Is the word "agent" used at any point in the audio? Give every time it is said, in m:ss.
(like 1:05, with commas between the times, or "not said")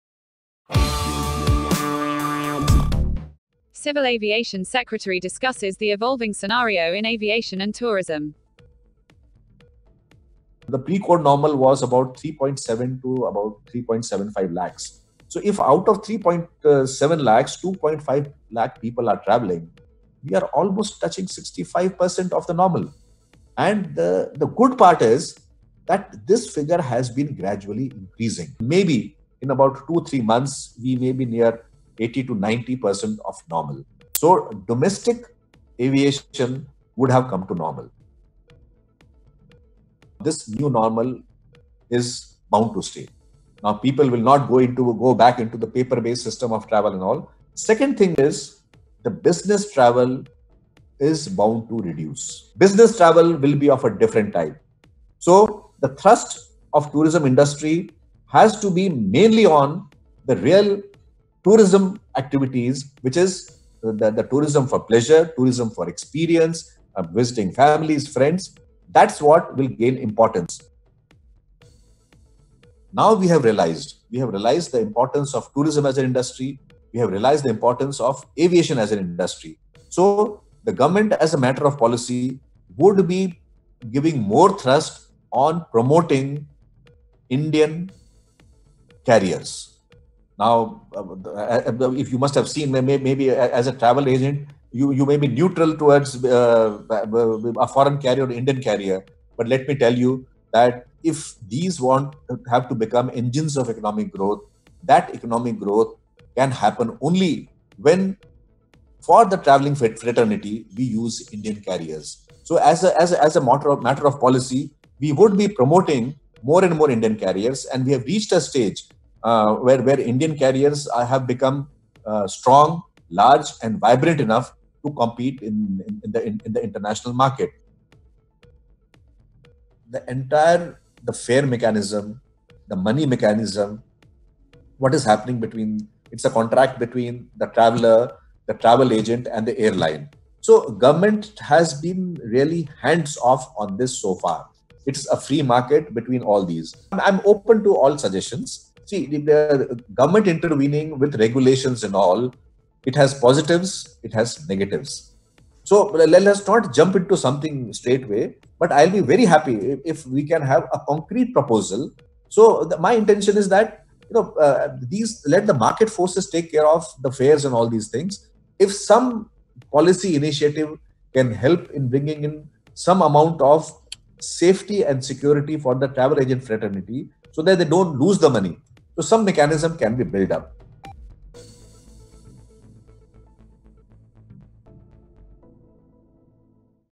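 1:34, 2:18, 2:56.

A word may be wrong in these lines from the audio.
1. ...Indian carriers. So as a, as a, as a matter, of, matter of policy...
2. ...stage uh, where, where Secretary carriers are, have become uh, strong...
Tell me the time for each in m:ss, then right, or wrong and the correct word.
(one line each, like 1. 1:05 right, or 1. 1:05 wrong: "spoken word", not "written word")
1. 1:51 right
2. 1:58 wrong: "Indian", not "Secretary".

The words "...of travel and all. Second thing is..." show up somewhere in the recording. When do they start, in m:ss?
0:46.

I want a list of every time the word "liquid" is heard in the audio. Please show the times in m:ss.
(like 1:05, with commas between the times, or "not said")
not said.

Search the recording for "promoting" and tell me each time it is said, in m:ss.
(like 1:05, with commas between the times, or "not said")
1:25, 1:55.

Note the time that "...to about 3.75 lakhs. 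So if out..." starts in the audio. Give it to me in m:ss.
0:13.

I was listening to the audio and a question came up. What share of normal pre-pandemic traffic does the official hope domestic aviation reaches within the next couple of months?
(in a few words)
80 to 90%.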